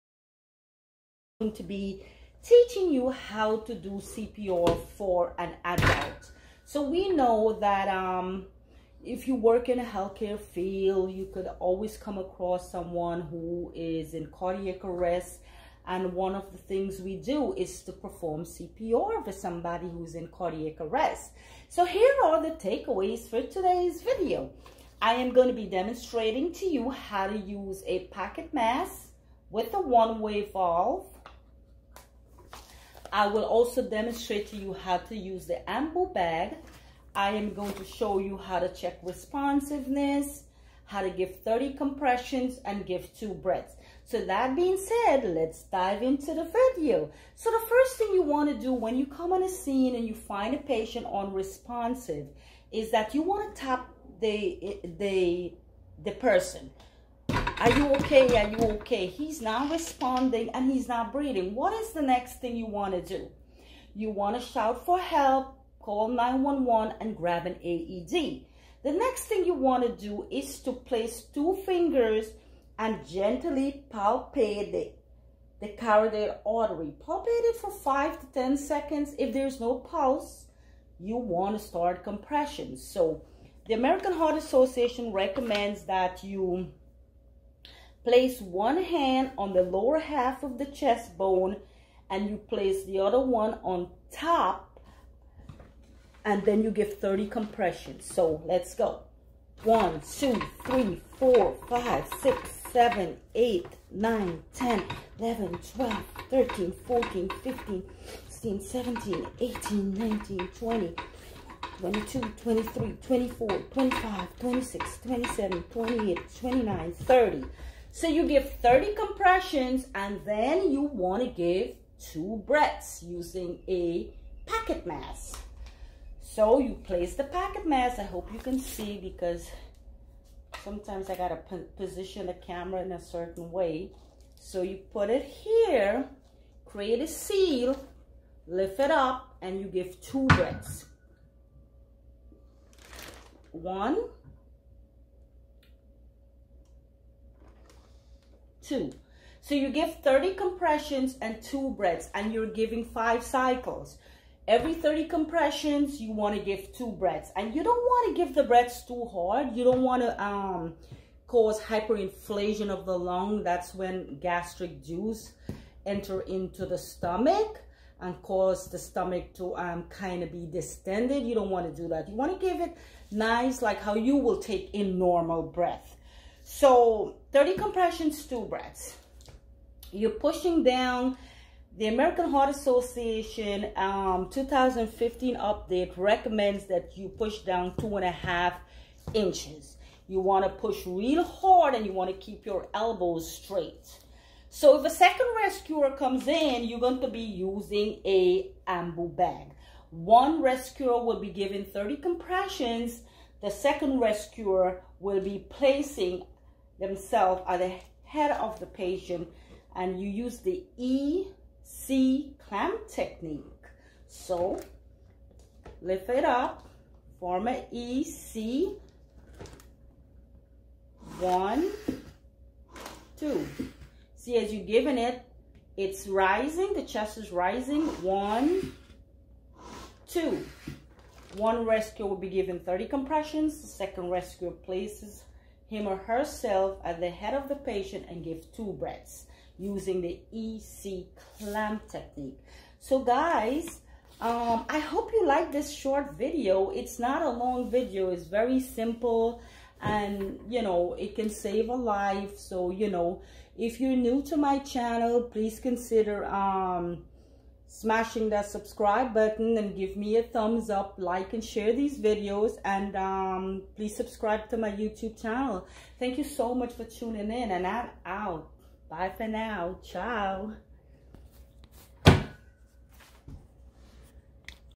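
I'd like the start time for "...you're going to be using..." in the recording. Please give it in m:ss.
3:16.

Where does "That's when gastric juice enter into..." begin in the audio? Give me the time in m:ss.
2:43.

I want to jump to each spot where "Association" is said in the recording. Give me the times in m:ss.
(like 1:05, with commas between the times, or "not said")
1:24, 3:02.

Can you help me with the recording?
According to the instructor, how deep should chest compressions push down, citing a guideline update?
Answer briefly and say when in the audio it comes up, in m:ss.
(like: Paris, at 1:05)
2.5 inches, at 3:07.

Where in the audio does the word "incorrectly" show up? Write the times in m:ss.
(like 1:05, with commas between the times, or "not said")
not said.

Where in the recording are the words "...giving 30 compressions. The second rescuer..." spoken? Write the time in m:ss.
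3:21.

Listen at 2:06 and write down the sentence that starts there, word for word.
So you place the pocket mask.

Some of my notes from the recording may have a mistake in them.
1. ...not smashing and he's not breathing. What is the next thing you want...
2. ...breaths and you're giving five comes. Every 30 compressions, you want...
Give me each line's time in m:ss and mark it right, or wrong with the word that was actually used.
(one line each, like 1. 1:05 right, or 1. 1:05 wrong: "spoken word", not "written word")
1. 0:59 wrong: "responding", not "smashing"
2. 2:31 wrong: "cycles", not "comes".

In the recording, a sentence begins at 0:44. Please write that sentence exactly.
So that being said, let's dive into the video.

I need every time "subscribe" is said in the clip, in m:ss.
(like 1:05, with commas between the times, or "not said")
4:18, 4:23.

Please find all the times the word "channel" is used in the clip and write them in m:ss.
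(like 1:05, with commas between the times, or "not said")
4:14, 4:25.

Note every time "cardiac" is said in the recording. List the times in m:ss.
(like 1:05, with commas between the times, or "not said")
0:14, 0:20.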